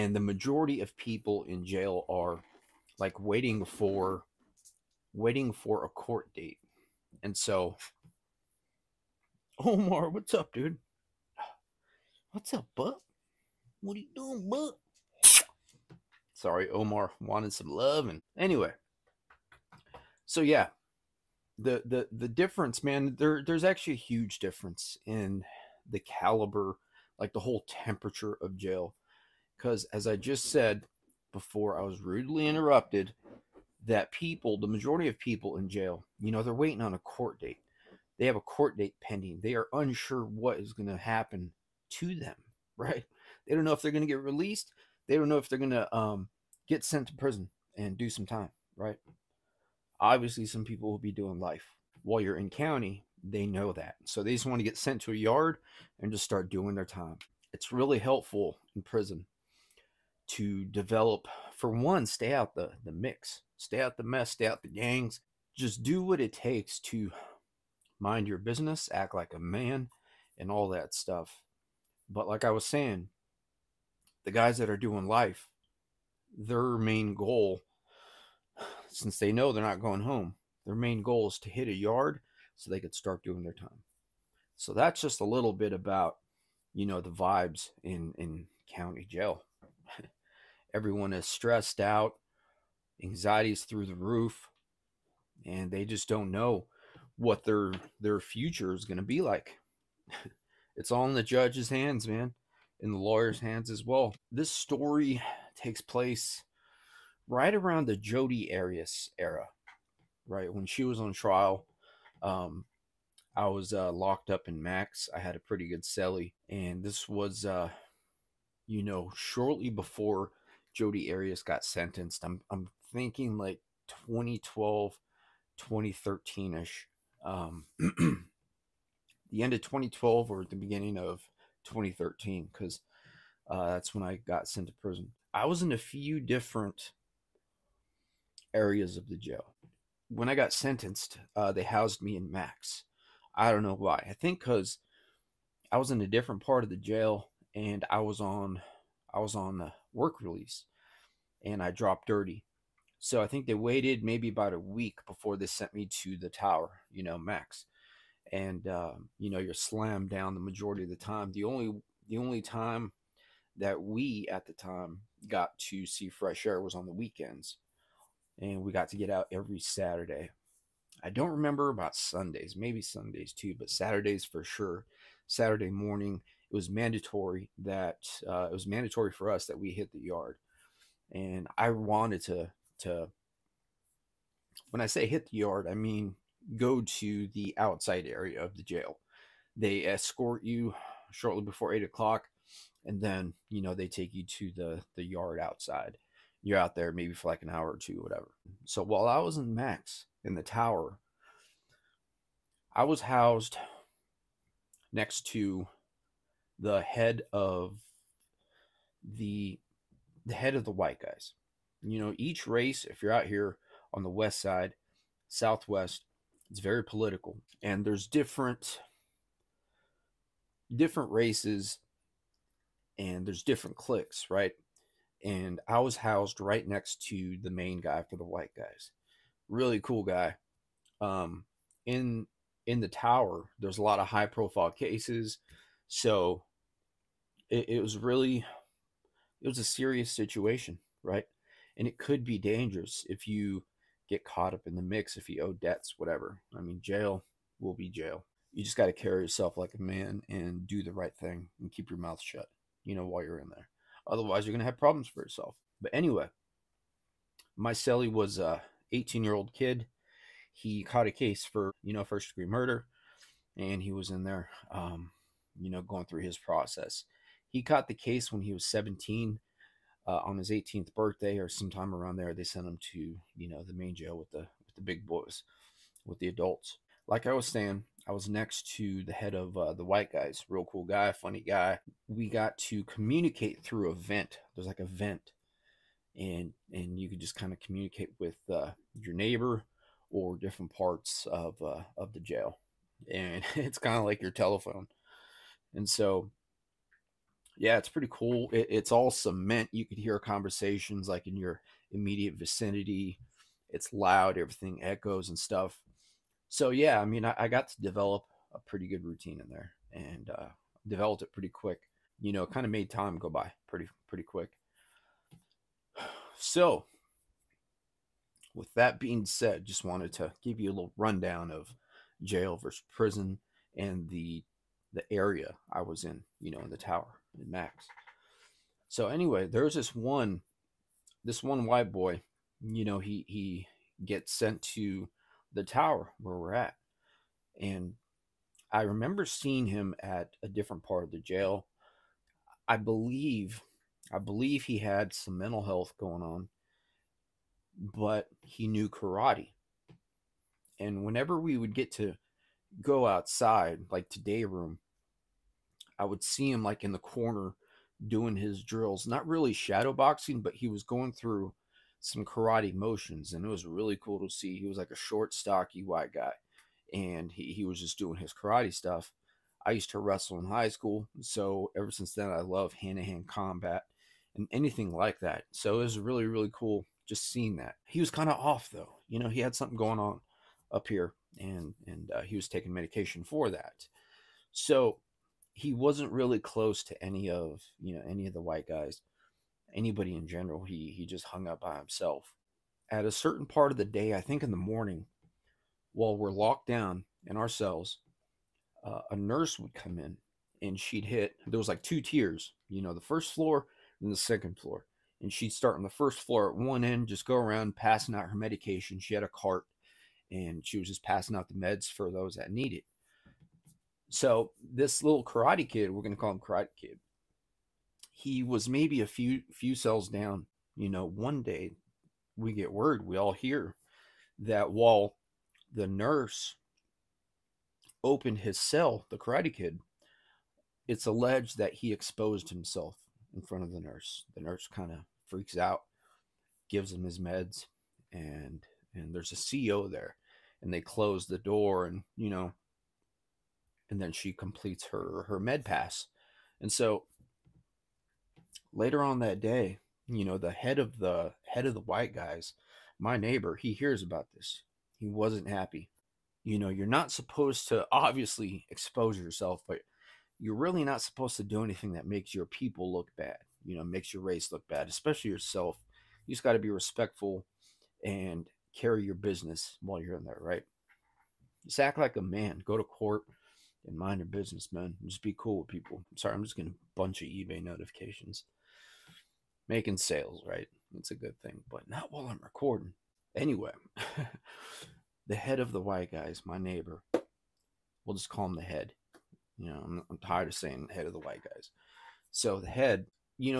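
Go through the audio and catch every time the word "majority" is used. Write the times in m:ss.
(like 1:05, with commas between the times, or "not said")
0:00, 0:34, 2:40.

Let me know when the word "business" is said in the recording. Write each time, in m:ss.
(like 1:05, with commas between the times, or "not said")
1:08, 7:49, 7:54.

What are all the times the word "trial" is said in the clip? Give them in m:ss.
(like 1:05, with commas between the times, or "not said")
1:51.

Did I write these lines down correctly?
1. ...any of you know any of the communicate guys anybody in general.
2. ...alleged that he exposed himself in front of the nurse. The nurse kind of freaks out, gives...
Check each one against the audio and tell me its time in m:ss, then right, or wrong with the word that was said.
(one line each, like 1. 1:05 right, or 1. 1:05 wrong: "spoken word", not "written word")
1. 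6:27 wrong: "white", not "communicate"
2. 7:11 right.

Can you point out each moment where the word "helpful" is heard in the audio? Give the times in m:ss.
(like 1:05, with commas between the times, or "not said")
0:57.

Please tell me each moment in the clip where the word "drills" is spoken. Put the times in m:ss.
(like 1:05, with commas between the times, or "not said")
5:58.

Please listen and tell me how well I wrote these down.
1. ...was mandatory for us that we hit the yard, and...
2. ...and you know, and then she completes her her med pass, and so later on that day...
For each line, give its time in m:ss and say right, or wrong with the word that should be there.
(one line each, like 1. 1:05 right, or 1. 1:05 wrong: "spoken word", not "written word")
1. 2:58 right
2. 7:21 right.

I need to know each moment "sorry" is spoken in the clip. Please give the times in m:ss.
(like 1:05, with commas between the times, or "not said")
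0:16, 7:56.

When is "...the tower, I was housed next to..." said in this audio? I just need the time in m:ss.
3:20.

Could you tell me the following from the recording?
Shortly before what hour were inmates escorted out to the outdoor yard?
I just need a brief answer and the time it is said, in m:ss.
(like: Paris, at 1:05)
8 o'clock, at 3:11.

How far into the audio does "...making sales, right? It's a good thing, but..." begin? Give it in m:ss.
7:59.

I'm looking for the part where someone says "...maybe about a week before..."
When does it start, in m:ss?
2:34.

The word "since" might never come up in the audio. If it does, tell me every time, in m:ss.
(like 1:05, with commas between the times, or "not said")
1:18, 6:11.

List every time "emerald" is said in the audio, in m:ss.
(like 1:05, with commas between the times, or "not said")
not said.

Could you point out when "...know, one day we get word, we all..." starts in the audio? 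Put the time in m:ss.
7:00.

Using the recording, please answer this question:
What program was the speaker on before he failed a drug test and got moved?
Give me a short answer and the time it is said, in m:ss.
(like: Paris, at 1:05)
Work release, at 2:29.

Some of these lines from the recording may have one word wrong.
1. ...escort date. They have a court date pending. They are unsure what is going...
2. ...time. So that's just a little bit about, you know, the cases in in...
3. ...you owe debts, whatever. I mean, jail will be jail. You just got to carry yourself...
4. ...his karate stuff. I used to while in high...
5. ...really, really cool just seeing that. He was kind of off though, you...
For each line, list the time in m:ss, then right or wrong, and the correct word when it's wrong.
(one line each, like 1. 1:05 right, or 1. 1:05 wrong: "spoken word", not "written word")
1. 0:36 wrong: "court", not "escort"
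2. 1:23 wrong: "vibes", not "cases"
3. 4:05 right
4. 6:08 wrong: "wrestle", not "while"
5. 6:15 right.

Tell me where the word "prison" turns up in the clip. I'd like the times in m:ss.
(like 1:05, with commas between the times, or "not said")
0:47, 0:58, 2:14, 5:22.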